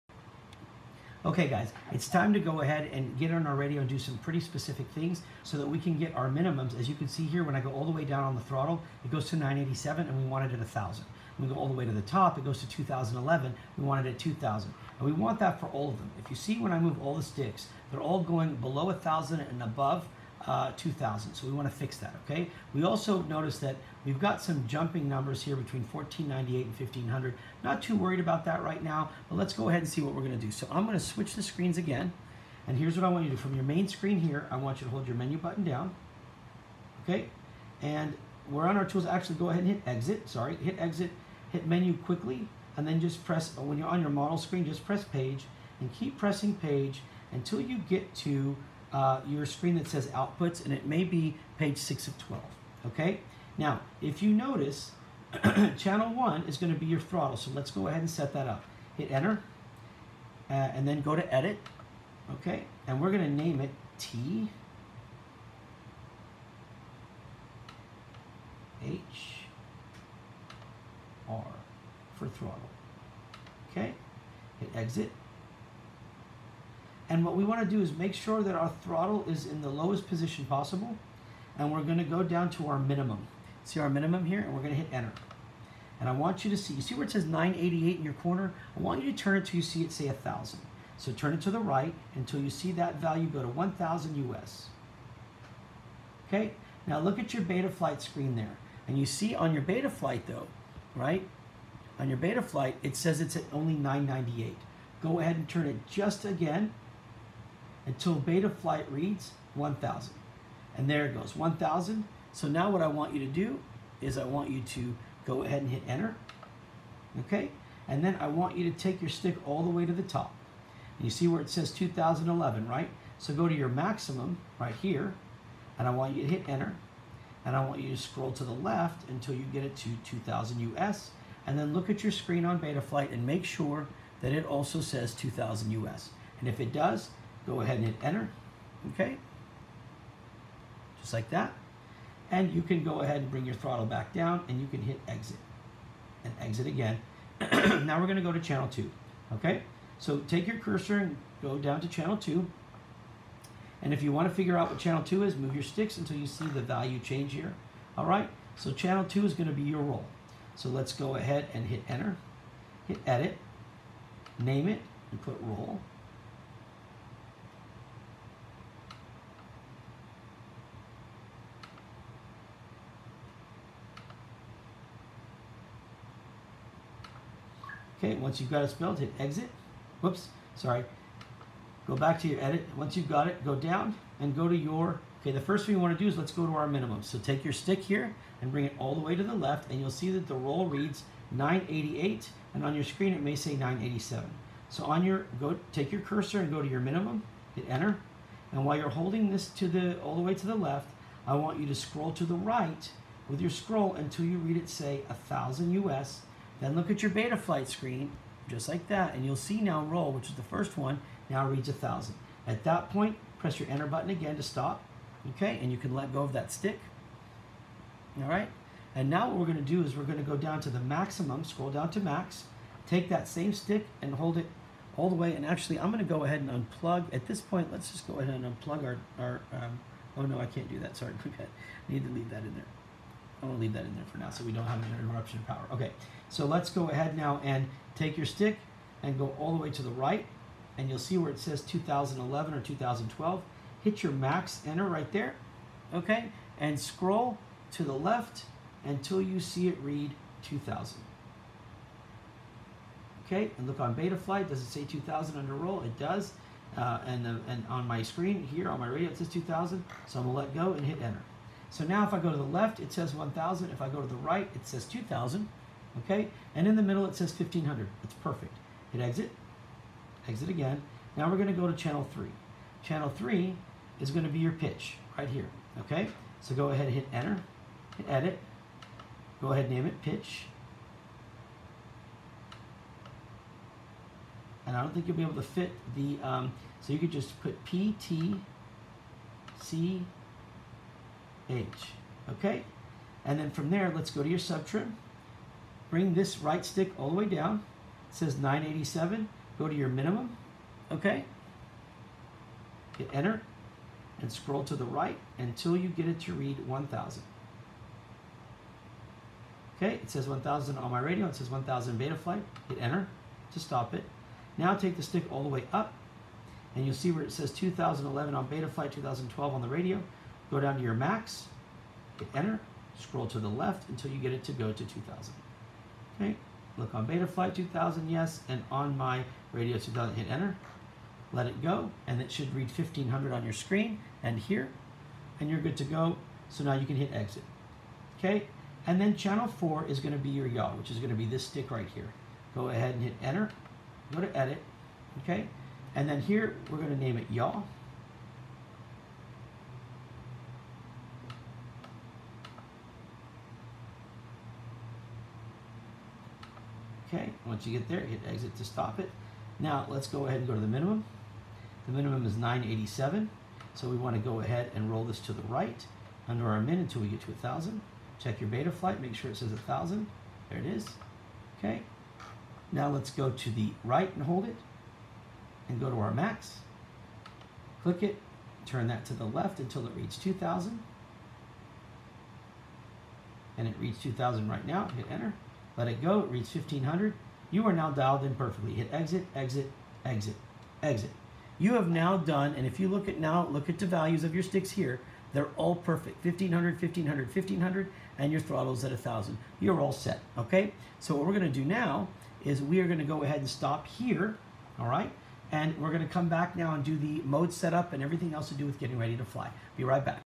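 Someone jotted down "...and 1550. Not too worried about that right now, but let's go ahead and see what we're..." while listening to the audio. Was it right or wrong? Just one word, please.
wrong.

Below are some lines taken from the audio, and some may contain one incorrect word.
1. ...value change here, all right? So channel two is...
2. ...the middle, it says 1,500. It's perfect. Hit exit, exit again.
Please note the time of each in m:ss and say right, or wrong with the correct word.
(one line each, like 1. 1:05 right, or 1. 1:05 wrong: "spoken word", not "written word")
1. 2:36 right
2. 4:26 right.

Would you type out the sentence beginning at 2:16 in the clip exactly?
And if it does, Go ahead and hit enter, okay?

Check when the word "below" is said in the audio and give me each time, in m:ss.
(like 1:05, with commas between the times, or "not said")
0:18.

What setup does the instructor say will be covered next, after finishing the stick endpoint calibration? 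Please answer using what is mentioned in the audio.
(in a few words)
mode setup.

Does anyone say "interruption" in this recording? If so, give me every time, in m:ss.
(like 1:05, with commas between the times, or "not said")
3:54.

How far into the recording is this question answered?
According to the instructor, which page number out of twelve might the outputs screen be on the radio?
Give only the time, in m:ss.
0:51.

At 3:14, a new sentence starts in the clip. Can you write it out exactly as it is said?
So on your, go take your cursor and go to your minimum, hit enter.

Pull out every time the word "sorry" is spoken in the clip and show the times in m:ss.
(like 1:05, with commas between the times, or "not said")
0:40, 3:00, 3:50.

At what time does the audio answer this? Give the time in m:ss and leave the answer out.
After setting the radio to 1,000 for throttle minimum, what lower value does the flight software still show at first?
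1:43.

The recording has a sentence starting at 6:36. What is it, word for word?
1500, 1500, 1500, and your throttle's at 1000.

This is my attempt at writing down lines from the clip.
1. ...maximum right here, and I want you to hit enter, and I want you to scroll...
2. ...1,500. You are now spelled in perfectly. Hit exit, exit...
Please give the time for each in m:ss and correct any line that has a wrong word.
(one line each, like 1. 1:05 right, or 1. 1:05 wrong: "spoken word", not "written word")
1. 2:03 right
2. 6:26 wrong: "dialed", not "spelled".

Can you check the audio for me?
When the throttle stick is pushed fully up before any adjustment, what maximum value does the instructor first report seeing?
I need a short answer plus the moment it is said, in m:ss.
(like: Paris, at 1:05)
2011, at 0:12.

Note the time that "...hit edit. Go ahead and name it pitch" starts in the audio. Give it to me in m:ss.
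4:37.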